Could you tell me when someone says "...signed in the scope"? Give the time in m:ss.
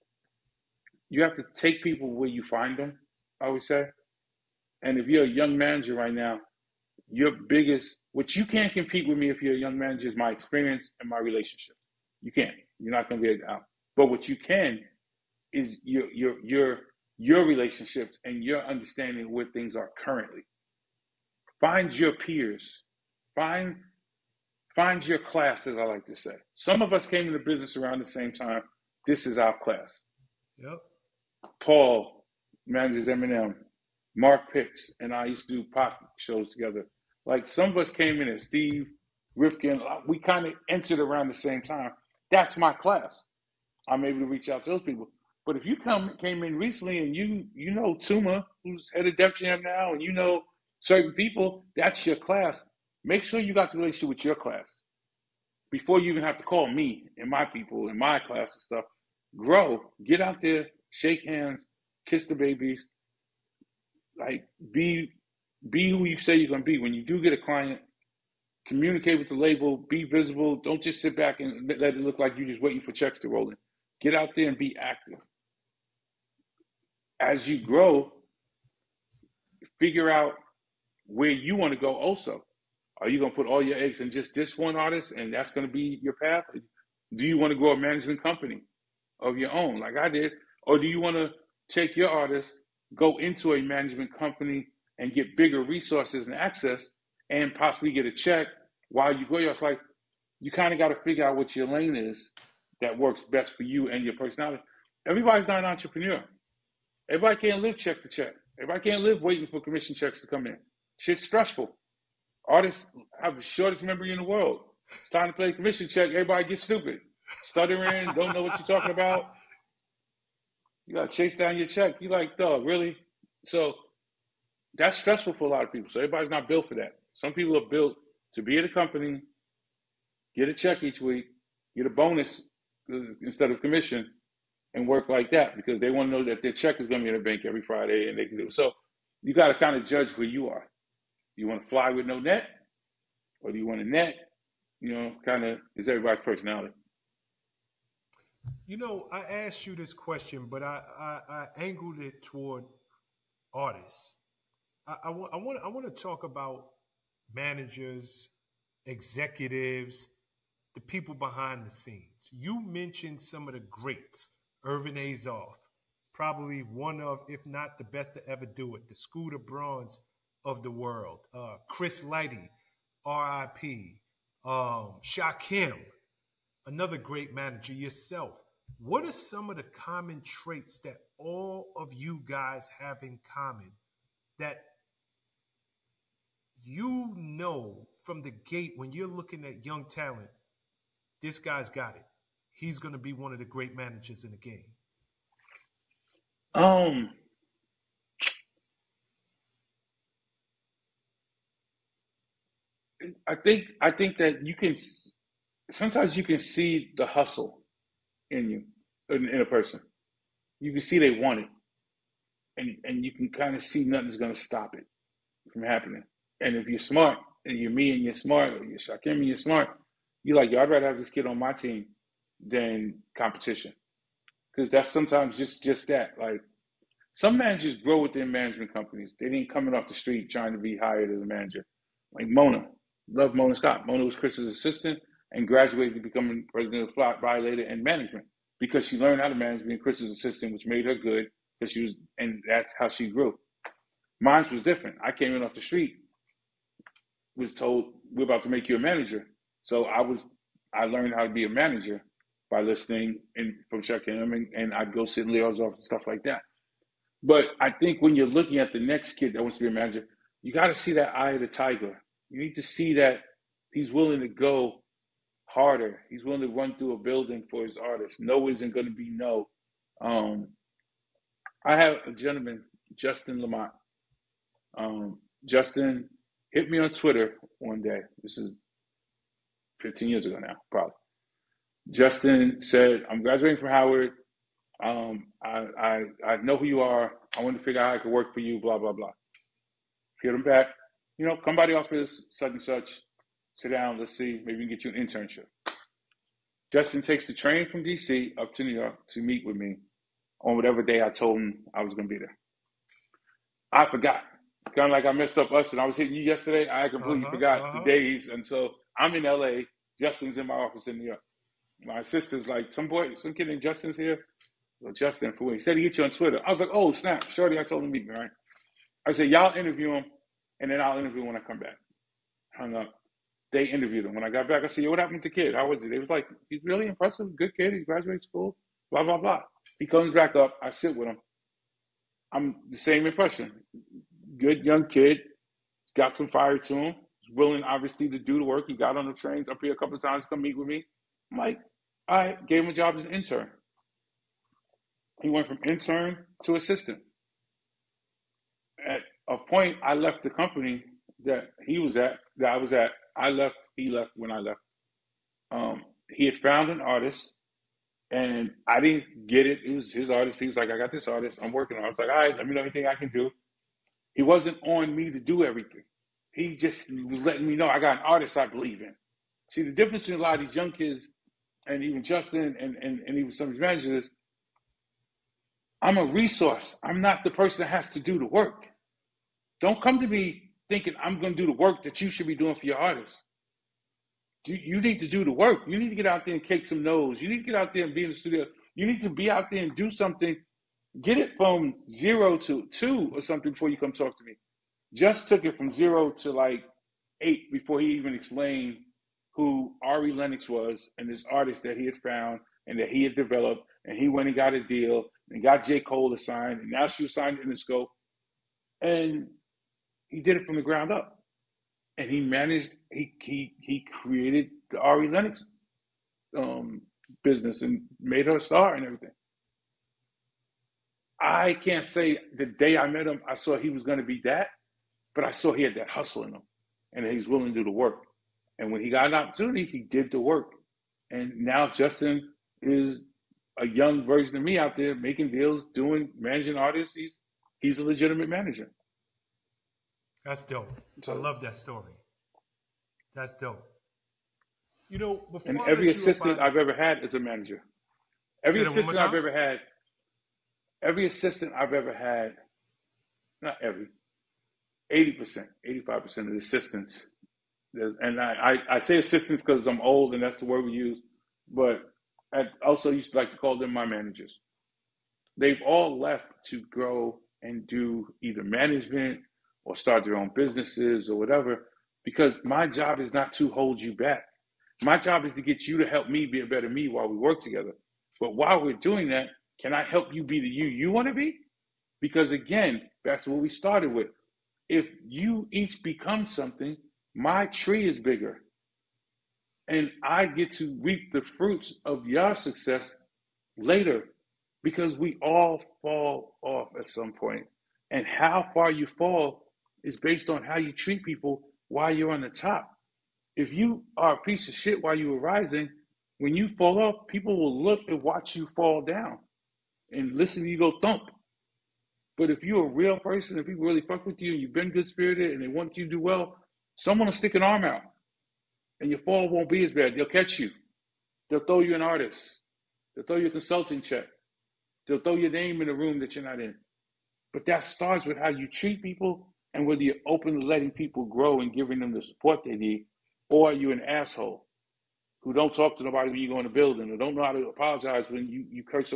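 6:47.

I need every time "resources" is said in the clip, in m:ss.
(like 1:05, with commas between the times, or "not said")
1:35, 6:16.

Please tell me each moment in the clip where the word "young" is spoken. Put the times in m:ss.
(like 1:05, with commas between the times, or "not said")
0:05, 0:09, 3:09, 5:34, 6:10, 7:13.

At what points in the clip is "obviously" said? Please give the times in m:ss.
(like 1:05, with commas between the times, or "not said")
5:37.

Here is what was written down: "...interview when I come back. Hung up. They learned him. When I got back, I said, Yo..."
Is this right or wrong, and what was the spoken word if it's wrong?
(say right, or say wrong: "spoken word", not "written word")
wrong: "interviewed", not "learned".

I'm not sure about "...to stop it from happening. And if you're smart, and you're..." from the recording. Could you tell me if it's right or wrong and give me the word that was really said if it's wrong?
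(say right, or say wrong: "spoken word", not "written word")
right.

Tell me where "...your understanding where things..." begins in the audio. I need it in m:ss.
0:18.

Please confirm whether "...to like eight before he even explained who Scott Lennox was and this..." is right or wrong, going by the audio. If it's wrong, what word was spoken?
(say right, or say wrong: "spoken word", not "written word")
wrong: "Ari", not "Scott".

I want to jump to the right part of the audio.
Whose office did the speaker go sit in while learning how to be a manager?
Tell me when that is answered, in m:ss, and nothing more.
4:15.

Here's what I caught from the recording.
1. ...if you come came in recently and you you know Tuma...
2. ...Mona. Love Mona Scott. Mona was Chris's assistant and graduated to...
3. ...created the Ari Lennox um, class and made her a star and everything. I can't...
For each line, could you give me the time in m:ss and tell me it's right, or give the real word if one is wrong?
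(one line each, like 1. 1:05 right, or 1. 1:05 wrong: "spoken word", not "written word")
1. 0:45 right
2. 3:52 right
3. 6:54 wrong: "business", not "class".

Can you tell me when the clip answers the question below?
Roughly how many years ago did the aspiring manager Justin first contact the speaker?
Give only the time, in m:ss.
4:39.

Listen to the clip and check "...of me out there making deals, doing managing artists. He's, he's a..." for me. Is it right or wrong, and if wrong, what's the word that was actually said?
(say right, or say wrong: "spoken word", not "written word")
right.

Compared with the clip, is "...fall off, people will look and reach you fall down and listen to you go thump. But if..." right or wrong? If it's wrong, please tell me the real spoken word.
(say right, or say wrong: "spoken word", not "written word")
wrong: "watch", not "reach".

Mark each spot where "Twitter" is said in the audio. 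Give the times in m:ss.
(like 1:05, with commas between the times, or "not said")
4:36, 5:16.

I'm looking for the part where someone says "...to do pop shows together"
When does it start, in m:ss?
0:35.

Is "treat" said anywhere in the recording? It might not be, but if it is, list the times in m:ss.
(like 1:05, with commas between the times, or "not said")
8:20, 8:48.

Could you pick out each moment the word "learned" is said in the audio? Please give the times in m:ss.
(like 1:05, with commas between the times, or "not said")
3:58, 4:10.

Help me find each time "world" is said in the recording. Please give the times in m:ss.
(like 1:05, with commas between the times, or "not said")
1:54, 2:50.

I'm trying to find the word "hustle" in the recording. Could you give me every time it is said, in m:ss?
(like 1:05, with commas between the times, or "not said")
3:27, 7:05.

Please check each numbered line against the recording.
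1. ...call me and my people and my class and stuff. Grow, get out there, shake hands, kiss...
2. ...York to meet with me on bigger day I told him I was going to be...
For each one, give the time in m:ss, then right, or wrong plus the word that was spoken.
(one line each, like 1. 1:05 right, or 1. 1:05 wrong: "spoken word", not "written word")
1. 0:56 right
2. 4:58 wrong: "whatever", not "bigger".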